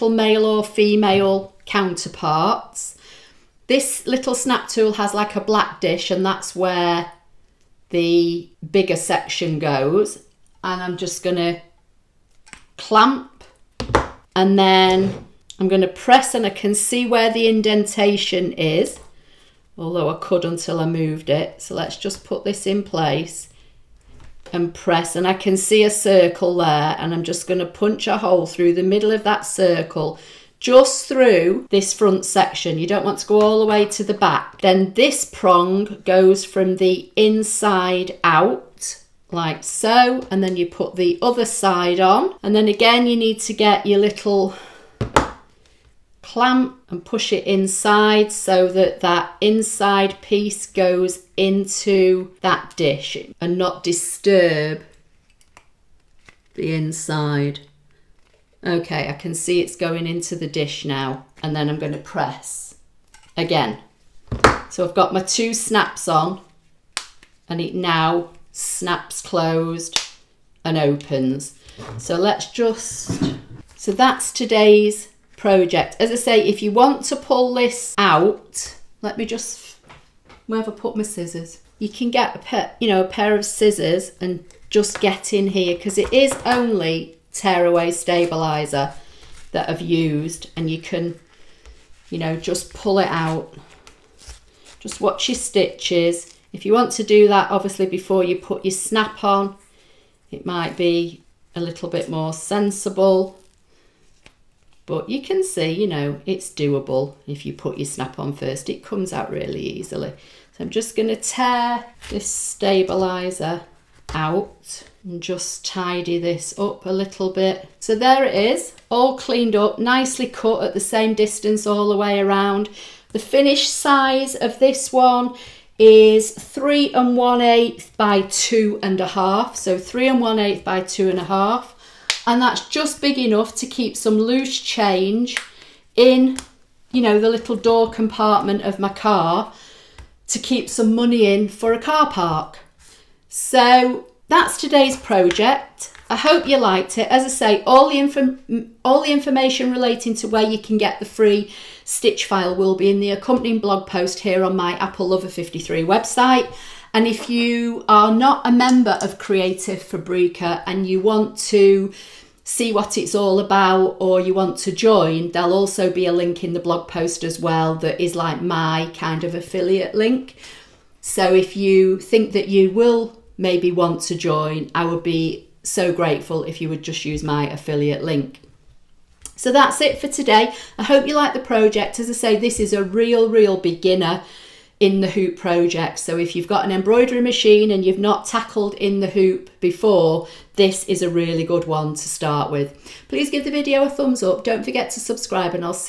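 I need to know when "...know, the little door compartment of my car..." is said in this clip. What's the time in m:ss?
2:17.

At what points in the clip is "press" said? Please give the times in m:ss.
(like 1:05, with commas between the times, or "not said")
0:15, 0:24, 1:01.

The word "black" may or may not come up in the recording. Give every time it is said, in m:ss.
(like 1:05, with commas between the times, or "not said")
0:05.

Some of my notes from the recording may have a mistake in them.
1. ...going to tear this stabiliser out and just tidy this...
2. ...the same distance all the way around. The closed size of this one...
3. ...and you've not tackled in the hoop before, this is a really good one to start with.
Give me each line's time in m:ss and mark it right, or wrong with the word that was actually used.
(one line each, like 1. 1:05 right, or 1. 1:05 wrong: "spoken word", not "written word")
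1. 1:50 right
2. 2:00 wrong: "finished", not "closed"
3. 3:07 right.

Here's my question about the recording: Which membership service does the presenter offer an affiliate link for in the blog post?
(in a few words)
Creative Fabrica.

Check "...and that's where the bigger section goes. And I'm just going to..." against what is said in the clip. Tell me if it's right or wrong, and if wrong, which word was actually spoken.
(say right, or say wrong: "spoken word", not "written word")
right.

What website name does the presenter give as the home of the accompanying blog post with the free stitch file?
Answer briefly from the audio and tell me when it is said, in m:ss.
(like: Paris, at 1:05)
Apple Lover 53, at 2:34.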